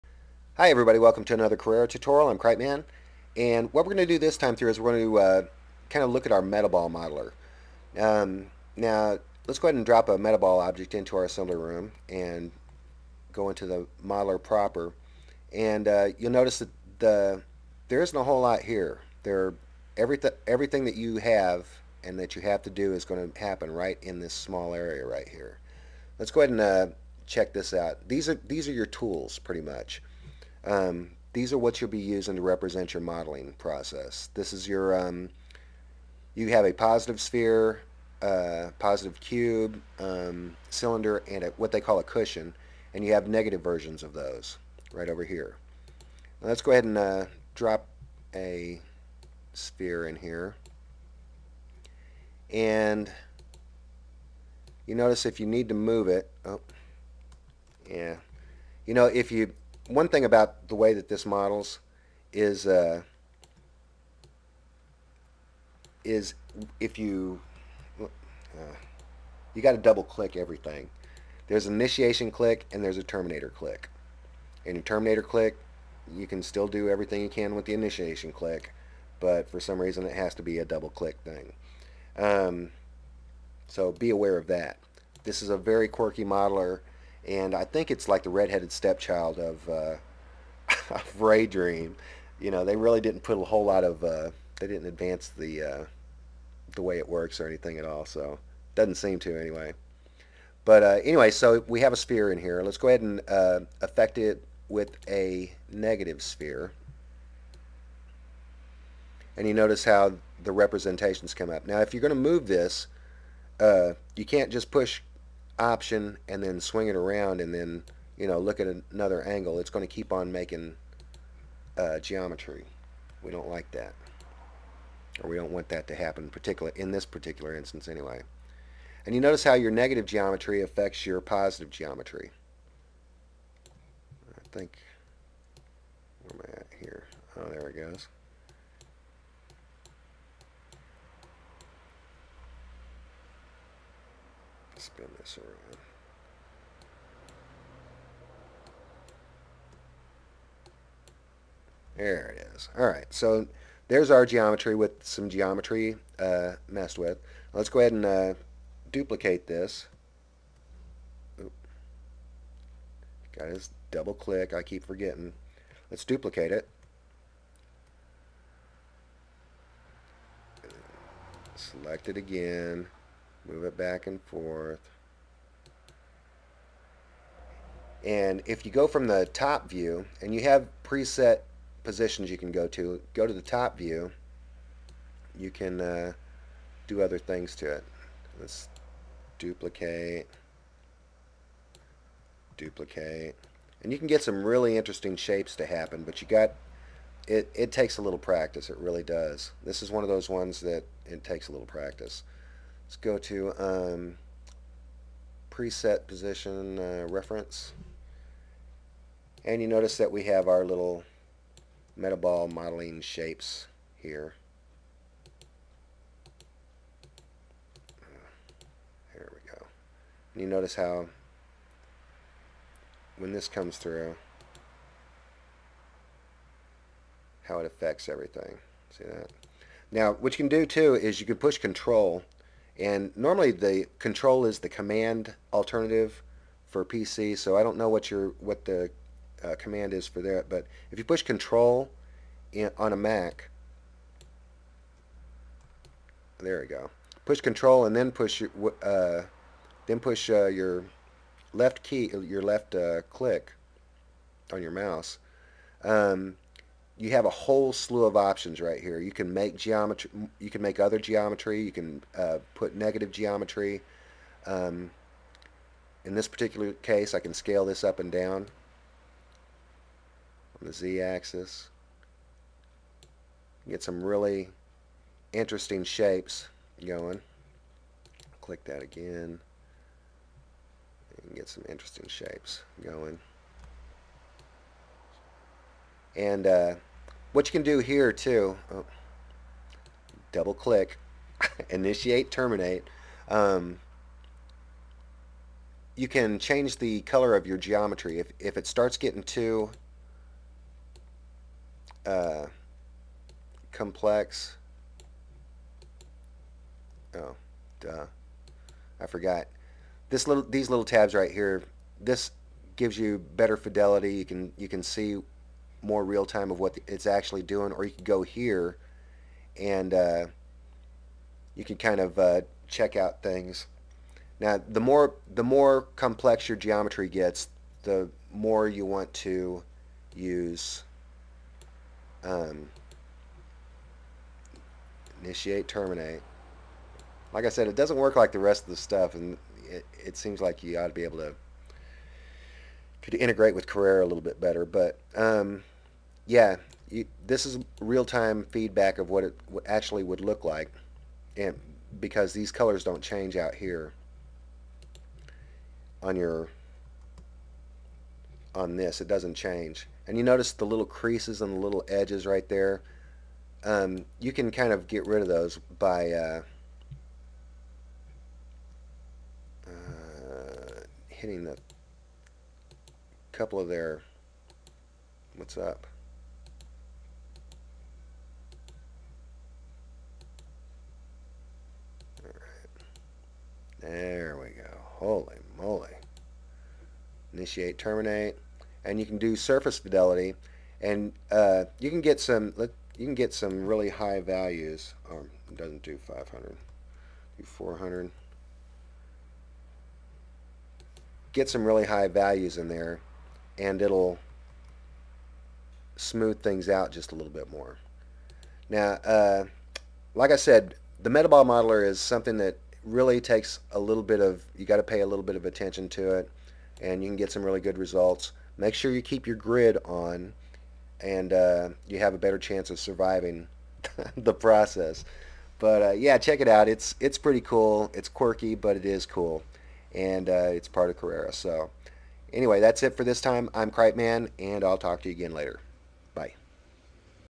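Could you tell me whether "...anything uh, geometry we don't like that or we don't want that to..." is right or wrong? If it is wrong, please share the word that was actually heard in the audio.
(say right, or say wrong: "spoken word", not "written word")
wrong: "making", not "anything".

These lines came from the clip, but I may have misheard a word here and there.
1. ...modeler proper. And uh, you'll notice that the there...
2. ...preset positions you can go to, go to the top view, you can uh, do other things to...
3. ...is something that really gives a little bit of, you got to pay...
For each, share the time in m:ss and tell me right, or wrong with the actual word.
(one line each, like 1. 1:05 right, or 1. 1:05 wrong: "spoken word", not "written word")
1. 0:14 right
2. 3:00 right
3. 6:51 wrong: "takes", not "gives".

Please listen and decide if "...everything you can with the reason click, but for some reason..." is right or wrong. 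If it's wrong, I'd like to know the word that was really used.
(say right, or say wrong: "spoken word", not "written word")
wrong: "initiation", not "reason".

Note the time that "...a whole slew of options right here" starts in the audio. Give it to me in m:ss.
4:17.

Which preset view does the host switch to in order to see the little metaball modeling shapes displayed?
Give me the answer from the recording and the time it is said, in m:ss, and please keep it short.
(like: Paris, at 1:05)
reference, at 3:27.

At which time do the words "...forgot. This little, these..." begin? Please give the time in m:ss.
5:09.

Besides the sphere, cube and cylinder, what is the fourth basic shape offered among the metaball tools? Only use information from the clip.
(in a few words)
cushion.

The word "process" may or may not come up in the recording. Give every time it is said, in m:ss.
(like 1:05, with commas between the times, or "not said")
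0:33, 7:04.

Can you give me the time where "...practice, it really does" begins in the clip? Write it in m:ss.
3:18.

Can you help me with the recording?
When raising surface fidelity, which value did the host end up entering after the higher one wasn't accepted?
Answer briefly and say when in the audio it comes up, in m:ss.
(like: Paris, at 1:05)
400, at 6:37.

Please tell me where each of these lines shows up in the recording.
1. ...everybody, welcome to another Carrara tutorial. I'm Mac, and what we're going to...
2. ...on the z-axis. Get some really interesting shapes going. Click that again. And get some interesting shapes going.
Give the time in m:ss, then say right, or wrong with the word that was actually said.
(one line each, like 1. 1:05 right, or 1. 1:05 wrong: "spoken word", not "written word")
1. 0:00 wrong: "Cripeman", not "Mac"
2. 4:30 right.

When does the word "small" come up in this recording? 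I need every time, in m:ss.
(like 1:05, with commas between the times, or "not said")
0:24.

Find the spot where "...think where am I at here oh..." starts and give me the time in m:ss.
2:14.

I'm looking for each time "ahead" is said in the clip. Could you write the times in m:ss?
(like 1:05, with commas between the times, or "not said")
0:09, 0:26, 0:46, 1:42, 2:37.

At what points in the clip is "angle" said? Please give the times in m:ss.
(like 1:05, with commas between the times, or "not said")
1:59.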